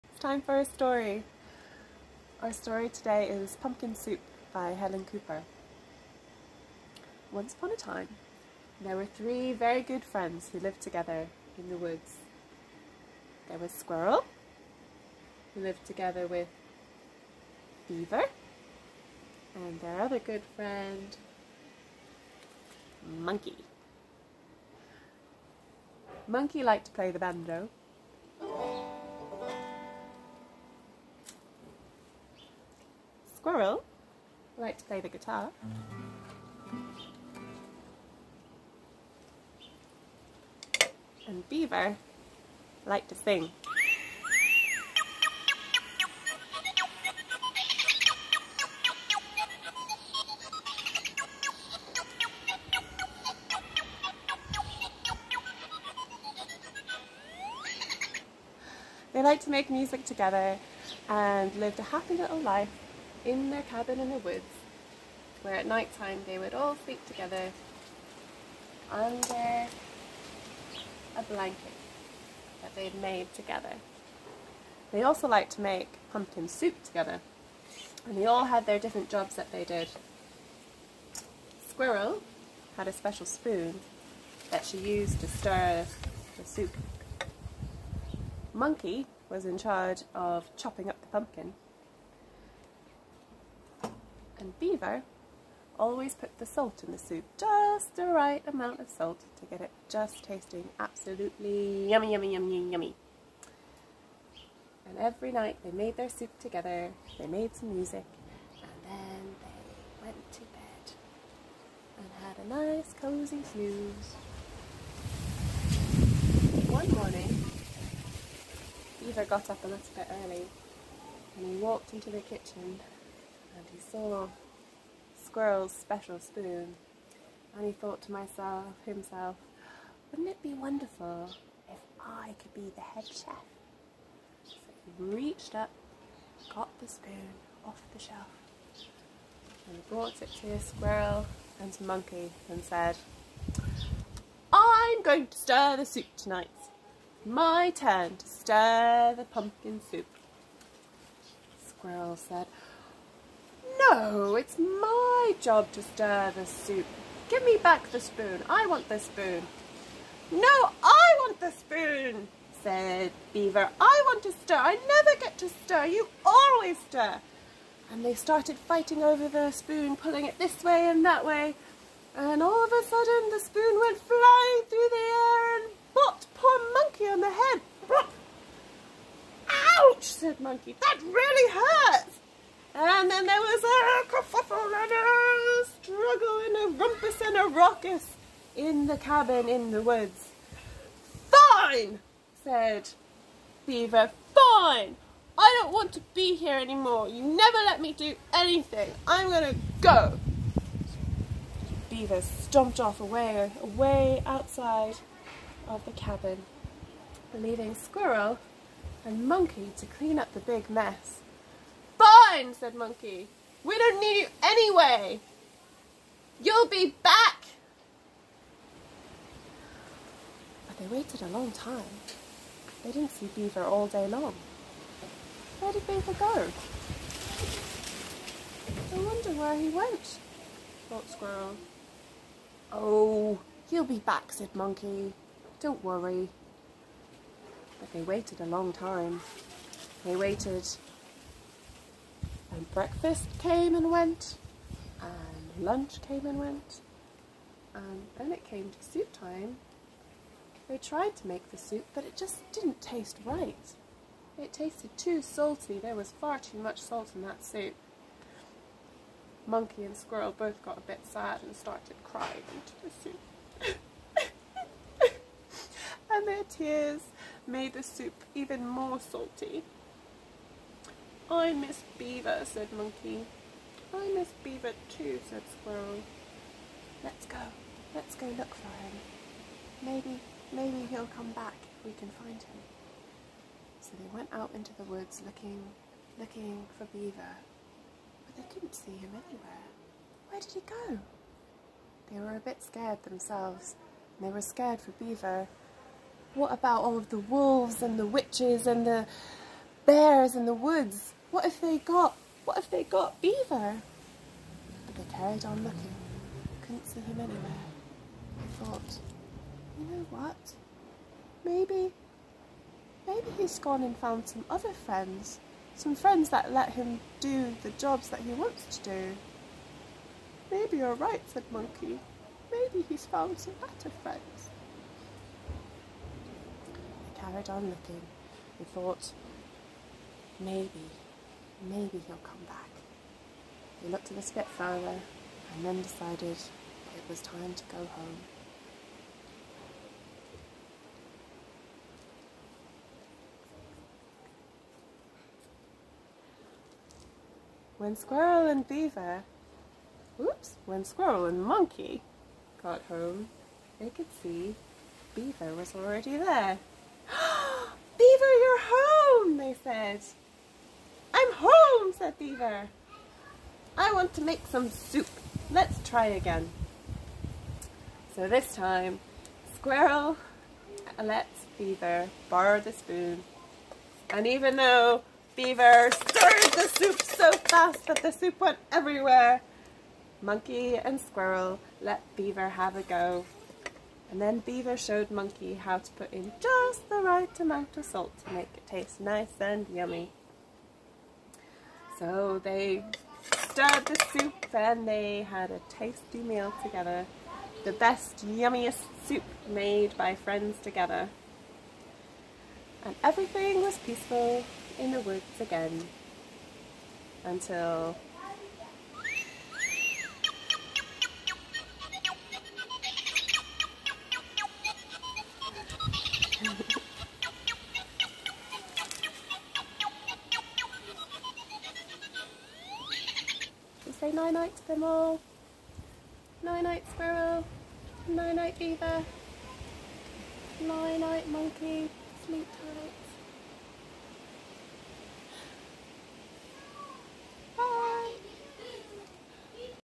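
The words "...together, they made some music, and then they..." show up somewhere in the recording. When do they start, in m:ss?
1:46.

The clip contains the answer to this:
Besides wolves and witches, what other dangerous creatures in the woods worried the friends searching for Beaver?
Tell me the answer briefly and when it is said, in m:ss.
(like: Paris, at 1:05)
Bears, at 4:59.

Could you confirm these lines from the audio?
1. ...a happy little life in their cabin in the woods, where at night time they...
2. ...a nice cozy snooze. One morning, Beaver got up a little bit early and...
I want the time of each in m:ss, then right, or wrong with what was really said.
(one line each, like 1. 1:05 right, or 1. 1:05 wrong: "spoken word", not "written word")
1. 1:01 right
2. 1:52 right.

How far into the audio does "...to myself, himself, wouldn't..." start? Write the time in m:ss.
2:08.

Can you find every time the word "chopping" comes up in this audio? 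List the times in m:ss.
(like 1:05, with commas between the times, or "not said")
1:30.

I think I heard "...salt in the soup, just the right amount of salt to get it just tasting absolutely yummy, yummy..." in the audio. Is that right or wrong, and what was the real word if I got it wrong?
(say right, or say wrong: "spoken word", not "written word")
right.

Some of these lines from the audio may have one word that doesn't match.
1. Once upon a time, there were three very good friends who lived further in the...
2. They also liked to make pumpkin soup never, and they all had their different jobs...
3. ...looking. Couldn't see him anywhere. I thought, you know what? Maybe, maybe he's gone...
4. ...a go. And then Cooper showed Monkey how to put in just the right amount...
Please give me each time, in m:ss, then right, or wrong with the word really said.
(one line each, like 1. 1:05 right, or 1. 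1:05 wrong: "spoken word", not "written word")
1. 0:07 wrong: "together", not "further"
2. 1:14 wrong: "together", not "never"
3. 5:05 right
4. 6:22 wrong: "Beaver", not "Cooper".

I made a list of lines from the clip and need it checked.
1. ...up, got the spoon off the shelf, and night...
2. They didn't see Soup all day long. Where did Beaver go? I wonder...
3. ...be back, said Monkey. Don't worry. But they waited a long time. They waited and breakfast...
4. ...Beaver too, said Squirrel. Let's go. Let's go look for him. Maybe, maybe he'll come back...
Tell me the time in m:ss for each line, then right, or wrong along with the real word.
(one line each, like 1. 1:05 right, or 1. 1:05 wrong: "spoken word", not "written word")
1. 2:15 wrong: "brought", not "night"
2. 3:42 wrong: "Beaver", not "Soup"
3. 3:53 right
4. 4:34 right.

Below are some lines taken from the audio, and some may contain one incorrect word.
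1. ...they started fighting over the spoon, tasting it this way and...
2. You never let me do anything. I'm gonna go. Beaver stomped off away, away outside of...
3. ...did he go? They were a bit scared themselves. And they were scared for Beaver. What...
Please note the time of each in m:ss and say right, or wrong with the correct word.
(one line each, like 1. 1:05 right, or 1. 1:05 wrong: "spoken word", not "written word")
1. 2:48 wrong: "pulling", not "tasting"
2. 3:17 right
3. 4:50 right.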